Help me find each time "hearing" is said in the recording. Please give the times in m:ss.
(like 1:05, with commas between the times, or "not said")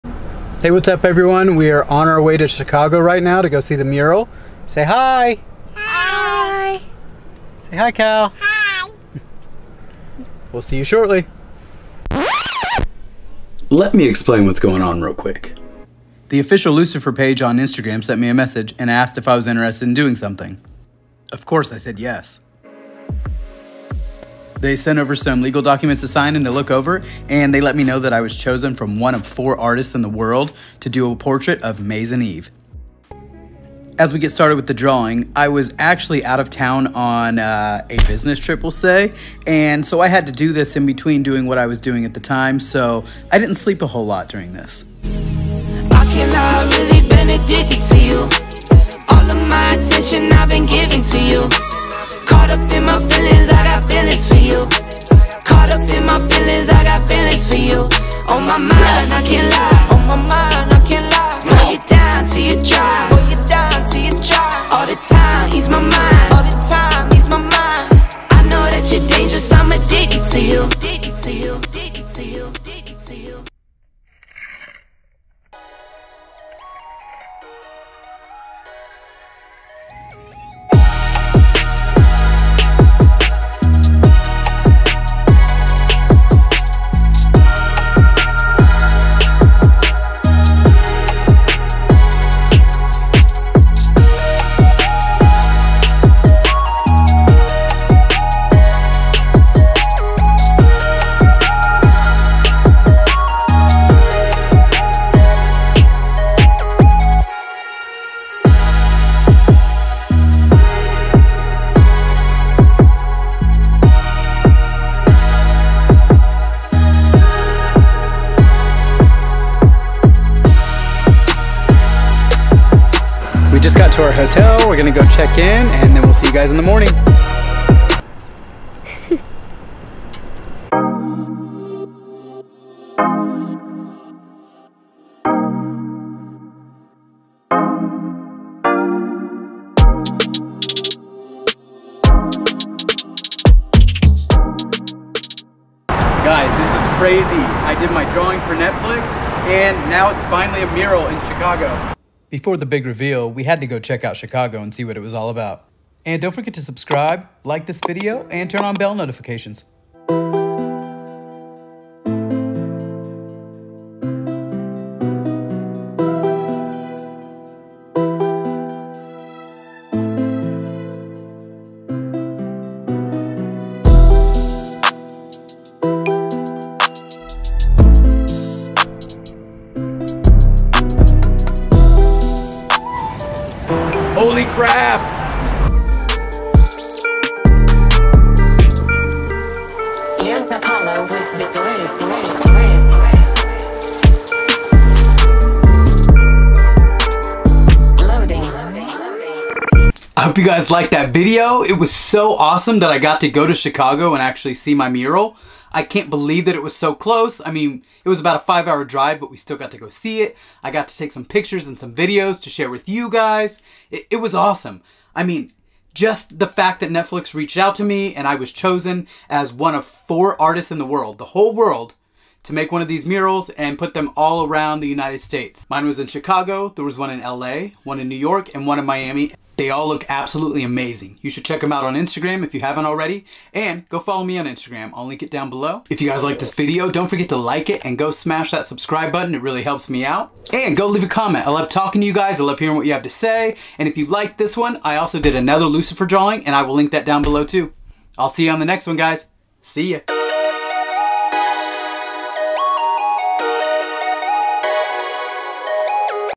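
4:02.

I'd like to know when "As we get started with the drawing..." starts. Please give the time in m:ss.
0:33.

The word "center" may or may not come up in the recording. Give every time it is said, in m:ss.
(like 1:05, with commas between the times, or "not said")
not said.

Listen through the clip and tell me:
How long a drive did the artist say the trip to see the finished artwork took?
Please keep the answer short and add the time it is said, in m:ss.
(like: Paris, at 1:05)
5 hours, at 3:28.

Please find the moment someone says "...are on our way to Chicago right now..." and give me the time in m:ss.
0:01.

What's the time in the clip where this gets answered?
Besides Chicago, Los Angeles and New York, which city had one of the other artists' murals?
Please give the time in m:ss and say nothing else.
3:48.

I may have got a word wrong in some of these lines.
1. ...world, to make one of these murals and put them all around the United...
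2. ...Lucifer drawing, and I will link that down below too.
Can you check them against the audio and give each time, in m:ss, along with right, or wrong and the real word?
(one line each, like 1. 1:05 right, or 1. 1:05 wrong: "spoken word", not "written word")
1. 3:41 right
2. 4:05 right.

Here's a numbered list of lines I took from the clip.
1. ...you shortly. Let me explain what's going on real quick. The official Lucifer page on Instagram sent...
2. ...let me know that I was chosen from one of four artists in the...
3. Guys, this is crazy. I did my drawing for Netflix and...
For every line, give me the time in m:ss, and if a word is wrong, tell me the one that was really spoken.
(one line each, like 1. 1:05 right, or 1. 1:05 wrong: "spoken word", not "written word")
1. 0:10 right
2. 0:27 right
3. 2:26 right.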